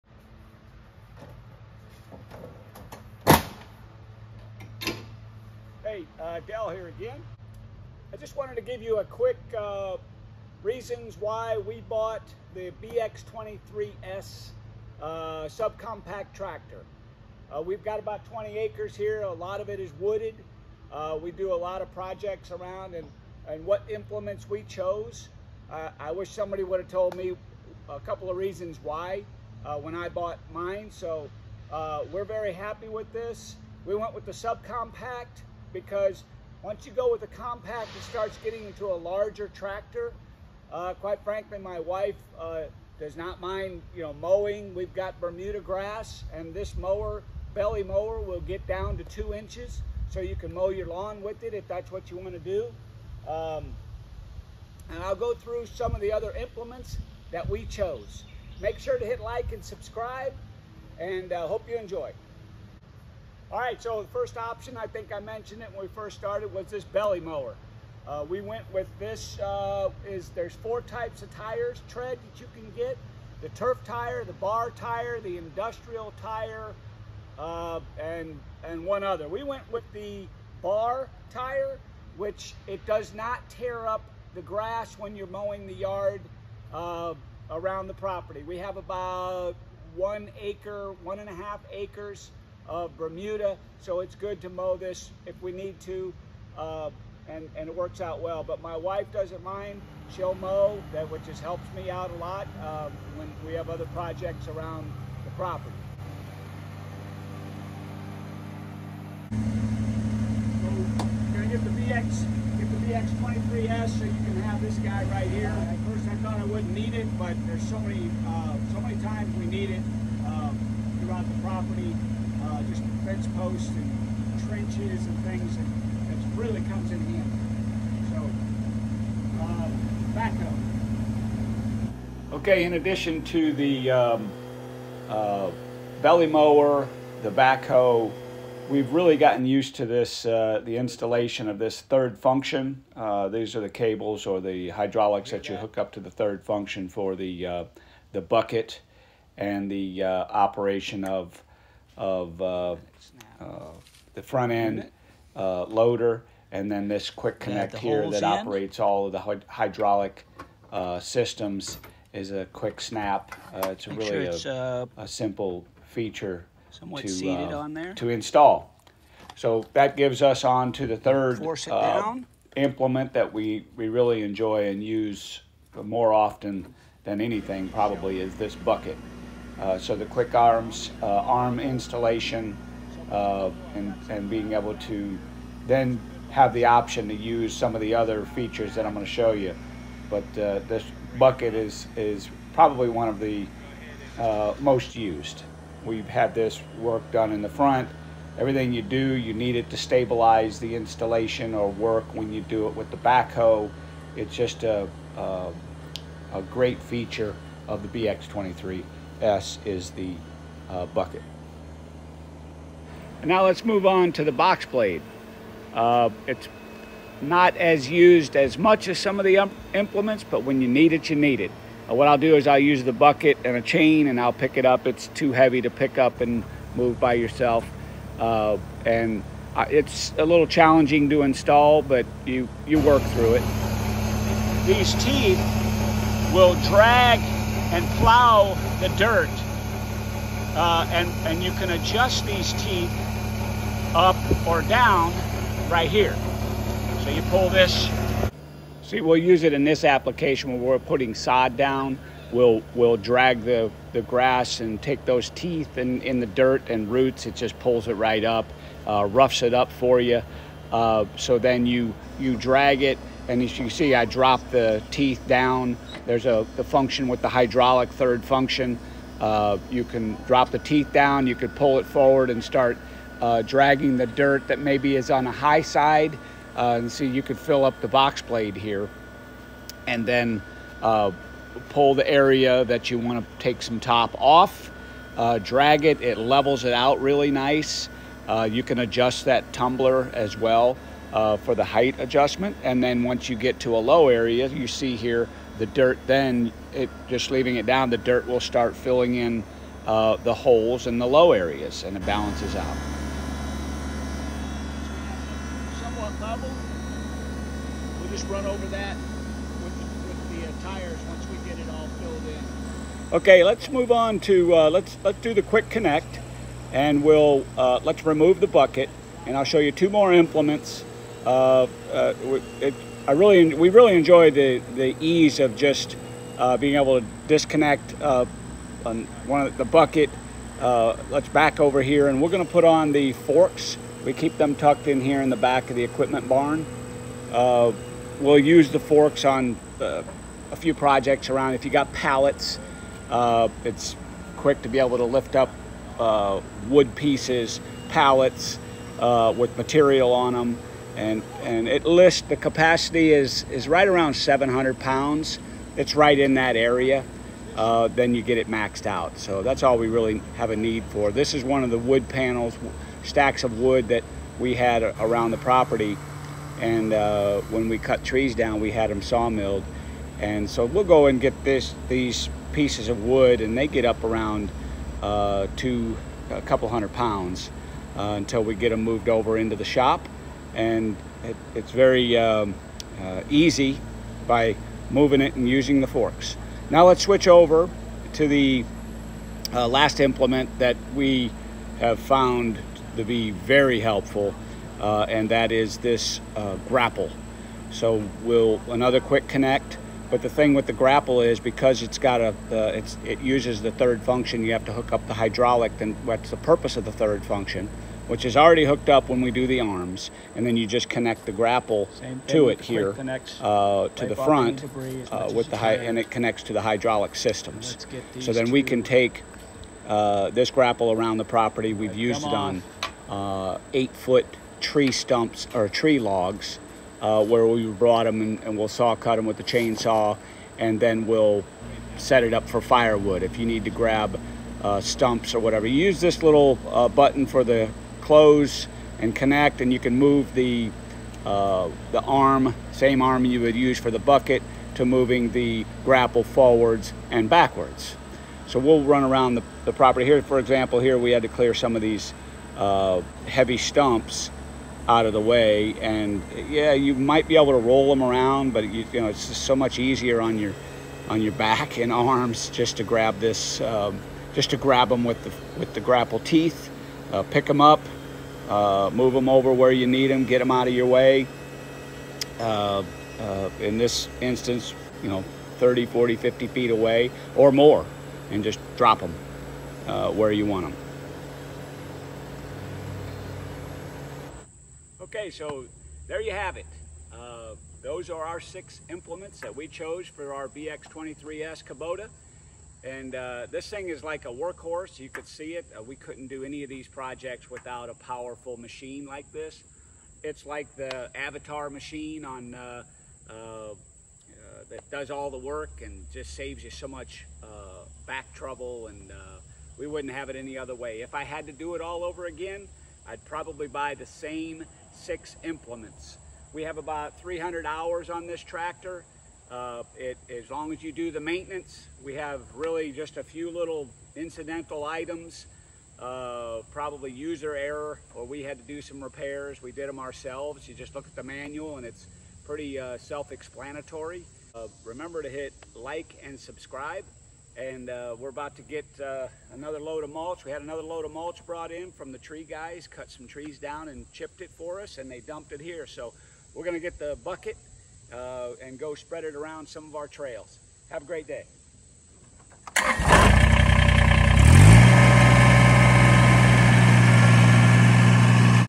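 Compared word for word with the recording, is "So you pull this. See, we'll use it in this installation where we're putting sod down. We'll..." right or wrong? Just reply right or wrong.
wrong.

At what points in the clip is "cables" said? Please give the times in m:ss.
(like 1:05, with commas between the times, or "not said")
2:23.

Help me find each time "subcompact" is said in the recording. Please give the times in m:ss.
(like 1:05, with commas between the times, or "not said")
0:15, 0:34.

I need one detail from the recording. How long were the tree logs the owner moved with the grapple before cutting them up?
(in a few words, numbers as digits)
8 feet.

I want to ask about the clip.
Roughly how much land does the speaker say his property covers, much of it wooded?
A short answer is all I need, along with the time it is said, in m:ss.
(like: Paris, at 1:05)
20 acres, at 0:18.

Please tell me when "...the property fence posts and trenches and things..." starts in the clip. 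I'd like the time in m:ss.
2:01.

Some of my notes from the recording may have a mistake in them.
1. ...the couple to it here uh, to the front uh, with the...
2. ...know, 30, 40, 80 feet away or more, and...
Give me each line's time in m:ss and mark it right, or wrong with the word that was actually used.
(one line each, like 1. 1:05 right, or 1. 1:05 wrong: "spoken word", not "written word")
1. 6:51 wrong: "grapple", not "couple"
2. 7:55 wrong: "50", not "80".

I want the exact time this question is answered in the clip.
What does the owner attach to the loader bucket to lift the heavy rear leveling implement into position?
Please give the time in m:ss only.
3:43.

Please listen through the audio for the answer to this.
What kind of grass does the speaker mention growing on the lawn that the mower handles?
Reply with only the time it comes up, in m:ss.
0:45.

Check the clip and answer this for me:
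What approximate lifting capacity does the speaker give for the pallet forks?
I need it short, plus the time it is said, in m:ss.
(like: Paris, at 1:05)
700 pounds, at 5:54.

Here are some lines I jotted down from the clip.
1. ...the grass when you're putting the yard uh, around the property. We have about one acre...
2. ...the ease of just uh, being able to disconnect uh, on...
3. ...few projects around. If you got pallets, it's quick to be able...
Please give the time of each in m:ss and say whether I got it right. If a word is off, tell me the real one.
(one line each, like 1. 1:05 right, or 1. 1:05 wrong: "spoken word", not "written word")
1. 1:24 wrong: "mowing", not "putting"
2. 5:24 right
3. 5:40 right.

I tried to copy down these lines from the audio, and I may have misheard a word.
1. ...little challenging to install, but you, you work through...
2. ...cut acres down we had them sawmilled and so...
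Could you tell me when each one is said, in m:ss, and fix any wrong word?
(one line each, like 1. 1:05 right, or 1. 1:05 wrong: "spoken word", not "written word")
1. 3:50 right
2. 6:07 wrong: "trees", not "acres".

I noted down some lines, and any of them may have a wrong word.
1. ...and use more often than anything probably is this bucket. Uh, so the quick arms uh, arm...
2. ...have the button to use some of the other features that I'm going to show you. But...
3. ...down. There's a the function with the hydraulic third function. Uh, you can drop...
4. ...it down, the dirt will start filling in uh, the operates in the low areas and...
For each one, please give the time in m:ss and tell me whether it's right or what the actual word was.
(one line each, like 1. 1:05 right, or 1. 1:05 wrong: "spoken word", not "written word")
1. 2:54 right
2. 3:06 wrong: "option", not "button"
3. 4:25 right
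4. 4:57 wrong: "holes", not "operates".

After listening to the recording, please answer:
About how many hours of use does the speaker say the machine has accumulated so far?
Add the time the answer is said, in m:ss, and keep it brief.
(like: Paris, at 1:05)
300 hours, at 8:37.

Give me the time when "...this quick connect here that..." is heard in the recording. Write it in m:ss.
2:36.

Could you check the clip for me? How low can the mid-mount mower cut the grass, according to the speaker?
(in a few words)
2 inches.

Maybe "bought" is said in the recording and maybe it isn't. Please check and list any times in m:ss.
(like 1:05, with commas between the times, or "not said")
0:11, 0:30.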